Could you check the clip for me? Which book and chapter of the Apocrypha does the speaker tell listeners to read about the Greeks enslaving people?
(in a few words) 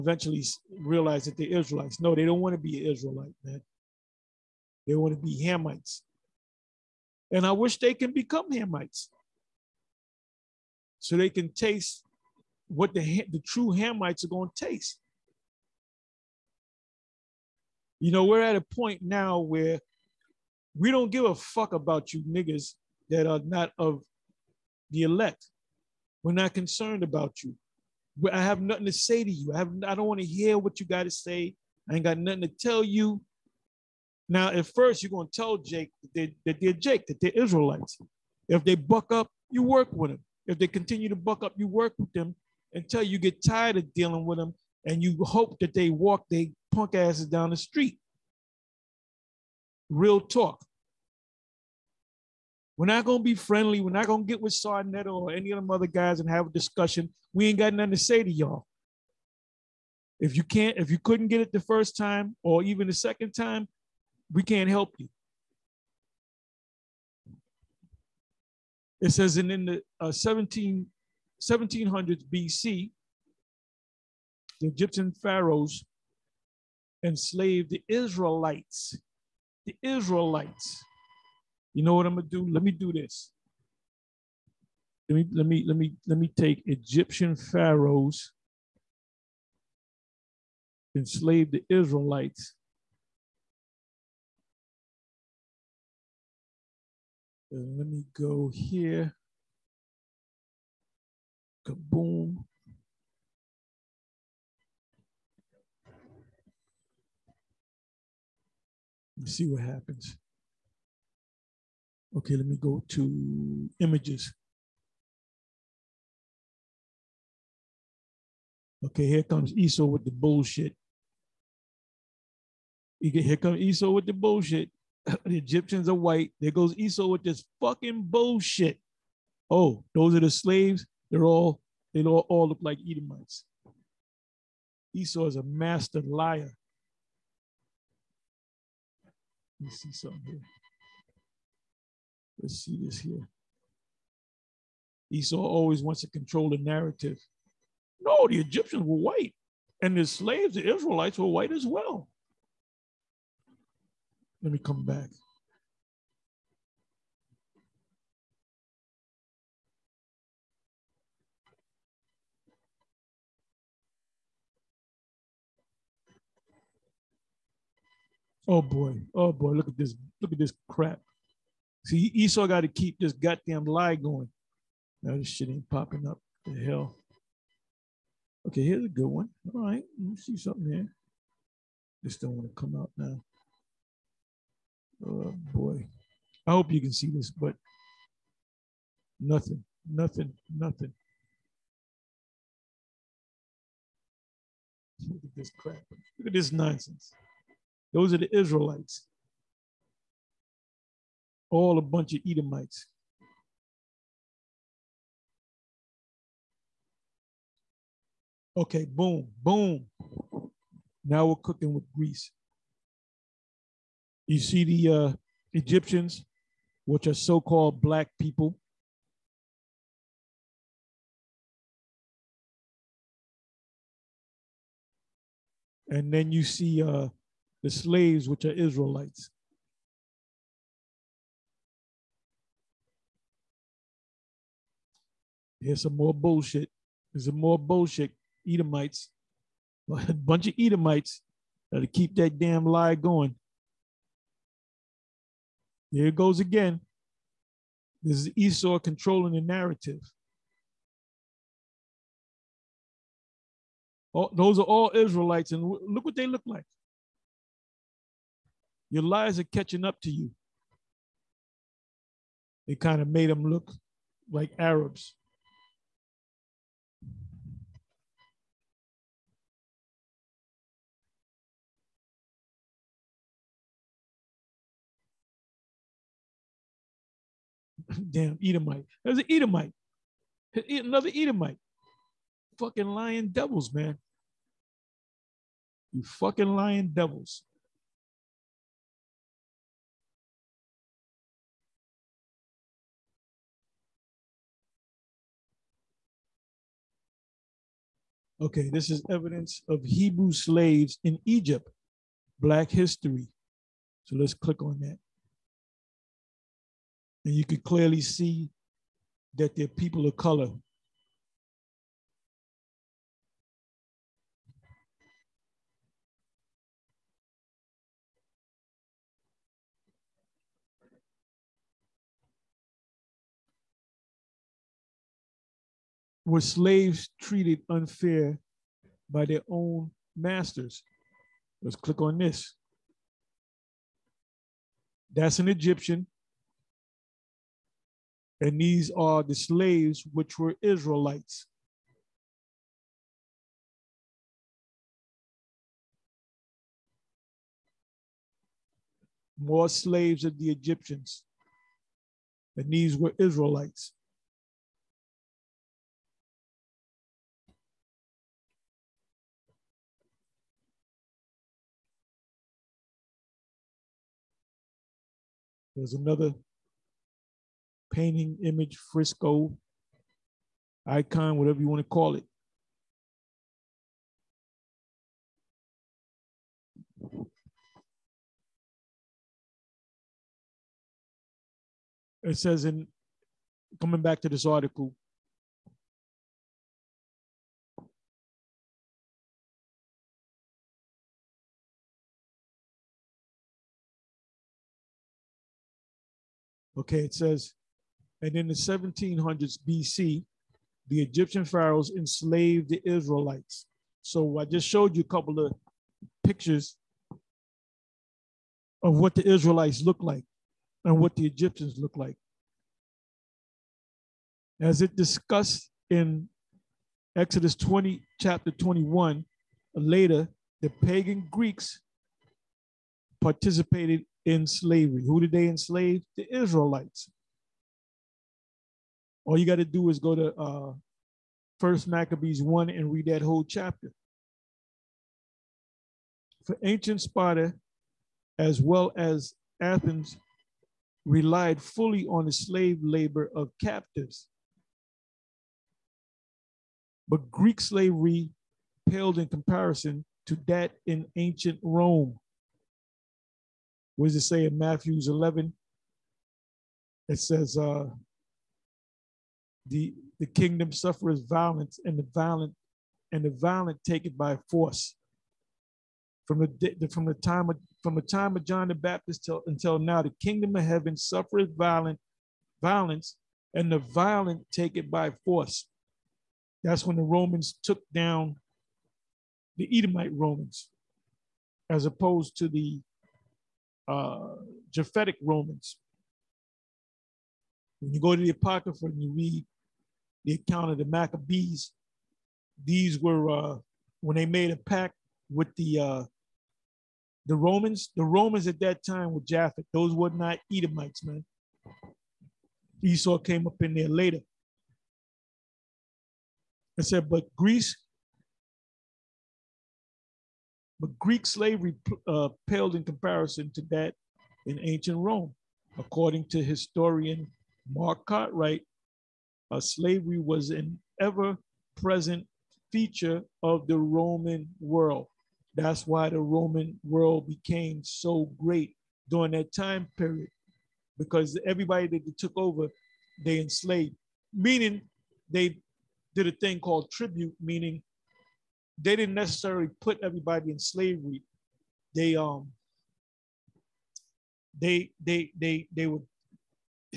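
First Maccabees 1.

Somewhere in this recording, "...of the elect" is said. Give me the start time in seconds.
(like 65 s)
23 s.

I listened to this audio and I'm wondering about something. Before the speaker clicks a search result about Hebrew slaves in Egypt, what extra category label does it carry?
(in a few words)
Black history.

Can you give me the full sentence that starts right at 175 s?
Now this shit ain't popping up.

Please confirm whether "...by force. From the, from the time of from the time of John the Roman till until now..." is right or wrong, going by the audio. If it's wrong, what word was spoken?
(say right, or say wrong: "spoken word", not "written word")
wrong: "Baptist", not "Roman".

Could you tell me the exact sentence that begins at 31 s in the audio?
I ain't got nothing to tell you.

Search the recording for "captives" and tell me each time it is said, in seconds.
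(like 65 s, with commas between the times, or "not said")
443 s.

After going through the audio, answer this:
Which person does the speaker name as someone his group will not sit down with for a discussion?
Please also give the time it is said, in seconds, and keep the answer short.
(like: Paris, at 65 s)
Sarnetta, at 54 s.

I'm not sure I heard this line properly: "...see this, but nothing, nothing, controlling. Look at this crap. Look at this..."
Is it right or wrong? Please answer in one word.
wrong.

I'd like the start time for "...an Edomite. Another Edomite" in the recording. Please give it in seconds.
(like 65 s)
279 s.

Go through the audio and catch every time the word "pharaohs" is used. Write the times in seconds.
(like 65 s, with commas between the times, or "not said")
75 s, 87 s, 401 s.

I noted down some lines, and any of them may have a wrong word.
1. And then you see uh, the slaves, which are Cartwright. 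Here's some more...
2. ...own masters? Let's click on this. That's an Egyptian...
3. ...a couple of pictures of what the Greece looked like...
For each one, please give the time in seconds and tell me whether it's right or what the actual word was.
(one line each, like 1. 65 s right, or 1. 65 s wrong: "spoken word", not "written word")
1. 225 s wrong: "Israelites", not "Cartwright"
2. 329 s right
3. 405 s wrong: "Israelites", not "Greece".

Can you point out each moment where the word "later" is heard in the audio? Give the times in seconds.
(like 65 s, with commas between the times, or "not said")
419 s, 503 s.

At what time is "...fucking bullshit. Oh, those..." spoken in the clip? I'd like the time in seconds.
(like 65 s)
127 s.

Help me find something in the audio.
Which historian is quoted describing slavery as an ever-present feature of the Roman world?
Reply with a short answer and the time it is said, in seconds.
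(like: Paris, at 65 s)
Mark Cartwright, at 517 s.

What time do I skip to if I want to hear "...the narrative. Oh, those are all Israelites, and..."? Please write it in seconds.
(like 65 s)
249 s.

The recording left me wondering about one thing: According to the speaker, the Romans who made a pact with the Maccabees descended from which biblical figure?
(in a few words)
Japhet.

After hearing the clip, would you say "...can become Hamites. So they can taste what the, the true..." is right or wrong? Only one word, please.
right.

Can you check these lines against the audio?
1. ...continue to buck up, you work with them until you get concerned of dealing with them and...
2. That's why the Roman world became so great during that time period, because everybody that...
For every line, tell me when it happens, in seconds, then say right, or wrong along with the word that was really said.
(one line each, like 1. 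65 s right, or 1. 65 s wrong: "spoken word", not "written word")
1. 40 s wrong: "tired", not "concerned"
2. 525 s right.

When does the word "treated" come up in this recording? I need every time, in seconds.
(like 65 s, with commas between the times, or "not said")
327 s.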